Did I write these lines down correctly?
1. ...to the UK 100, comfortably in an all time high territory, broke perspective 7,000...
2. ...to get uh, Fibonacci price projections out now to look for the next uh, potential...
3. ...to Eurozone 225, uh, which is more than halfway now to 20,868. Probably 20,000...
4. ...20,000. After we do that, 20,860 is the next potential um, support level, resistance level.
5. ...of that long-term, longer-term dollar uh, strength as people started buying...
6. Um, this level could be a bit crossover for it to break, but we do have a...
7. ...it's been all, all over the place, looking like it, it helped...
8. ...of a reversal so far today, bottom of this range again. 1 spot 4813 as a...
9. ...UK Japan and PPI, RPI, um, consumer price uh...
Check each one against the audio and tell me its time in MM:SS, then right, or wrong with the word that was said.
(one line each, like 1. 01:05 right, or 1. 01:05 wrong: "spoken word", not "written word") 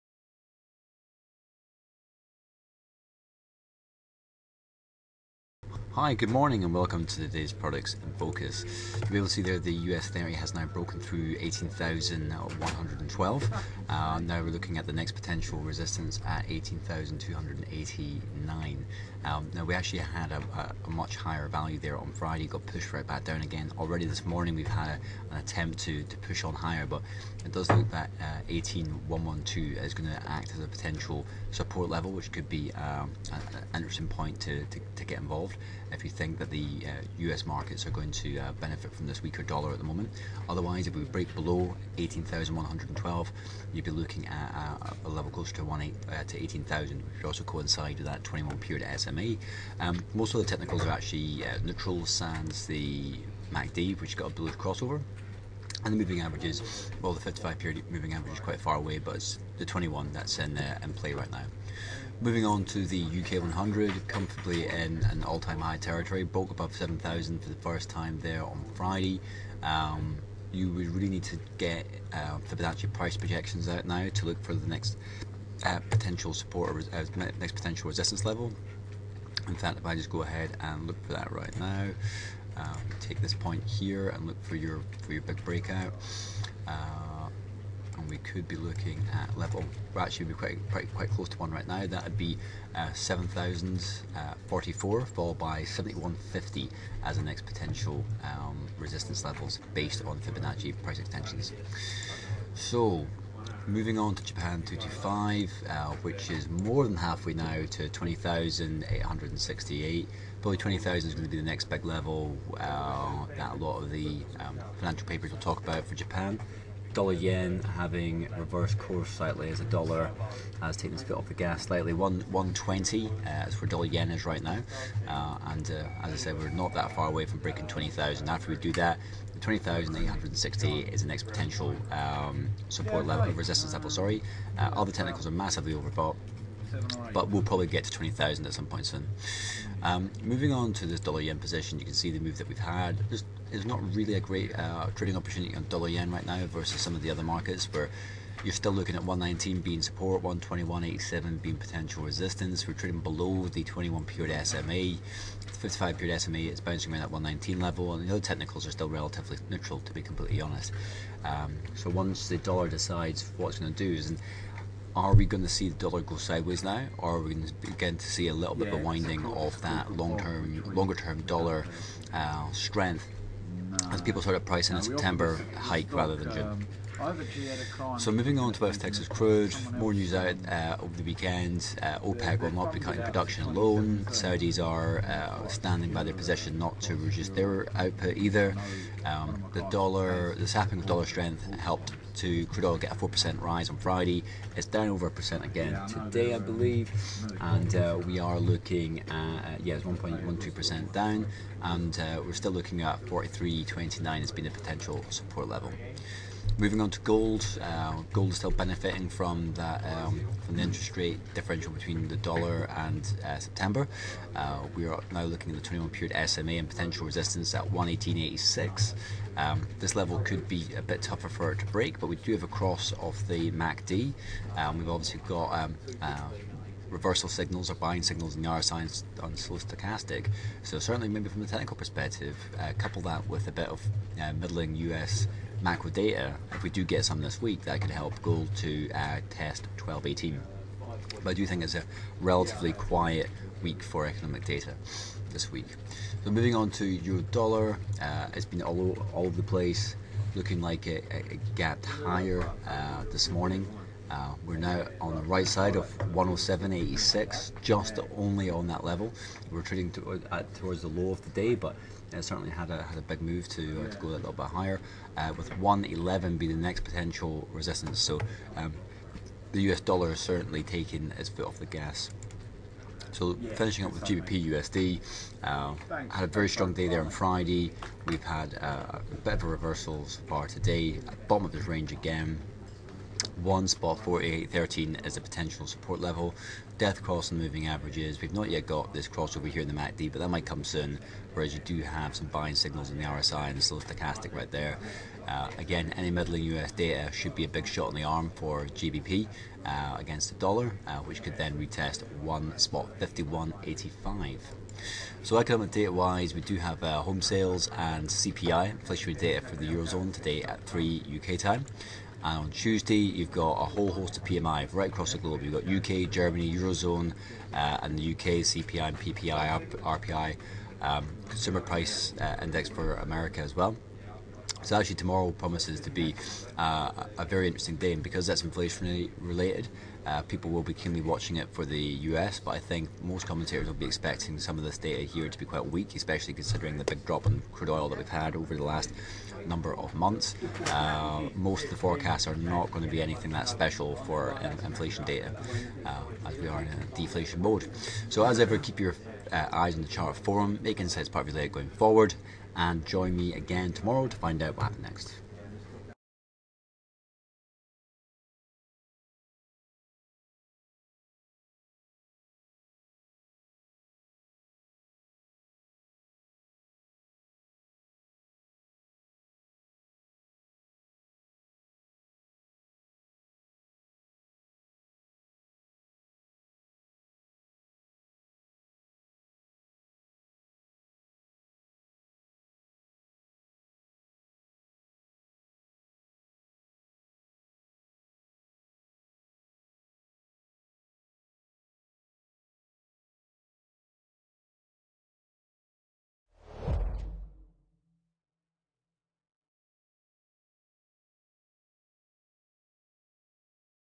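1. 01:02 wrong: "above", not "perspective"
2. 01:11 right
3. 01:44 wrong: "Japan", not "Eurozone"
4. 02:07 right
5. 02:49 wrong: "pricing", not "buying"
6. 03:39 wrong: "tougher", not "crossover"
7. 04:08 wrong: "gapped", not "helped"
8. 04:39 right
9. 05:18 wrong: "CPI", not "Japan".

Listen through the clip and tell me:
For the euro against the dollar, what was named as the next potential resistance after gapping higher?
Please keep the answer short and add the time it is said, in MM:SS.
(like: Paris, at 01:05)
111, at 04:25.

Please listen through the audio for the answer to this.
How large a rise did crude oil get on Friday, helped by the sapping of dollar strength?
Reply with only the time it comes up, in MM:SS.
03:12.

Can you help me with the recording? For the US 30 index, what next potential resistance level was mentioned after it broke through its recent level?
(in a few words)
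18,289.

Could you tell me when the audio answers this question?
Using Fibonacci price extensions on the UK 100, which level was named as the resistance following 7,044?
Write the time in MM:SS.
01:35.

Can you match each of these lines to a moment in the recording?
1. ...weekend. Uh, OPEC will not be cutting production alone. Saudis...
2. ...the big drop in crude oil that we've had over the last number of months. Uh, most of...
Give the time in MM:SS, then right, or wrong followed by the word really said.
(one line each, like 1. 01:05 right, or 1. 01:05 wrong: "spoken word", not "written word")
1. 03:01 right
2. 05:36 right.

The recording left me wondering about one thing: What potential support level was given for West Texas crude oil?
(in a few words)
43.29.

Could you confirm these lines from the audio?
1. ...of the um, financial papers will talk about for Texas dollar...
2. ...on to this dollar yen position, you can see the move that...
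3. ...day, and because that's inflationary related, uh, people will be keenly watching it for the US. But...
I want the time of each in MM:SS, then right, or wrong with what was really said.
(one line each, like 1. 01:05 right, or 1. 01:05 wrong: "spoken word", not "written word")
1. 01:53 wrong: "Japan", not "Texas"
2. 02:20 right
3. 05:27 right.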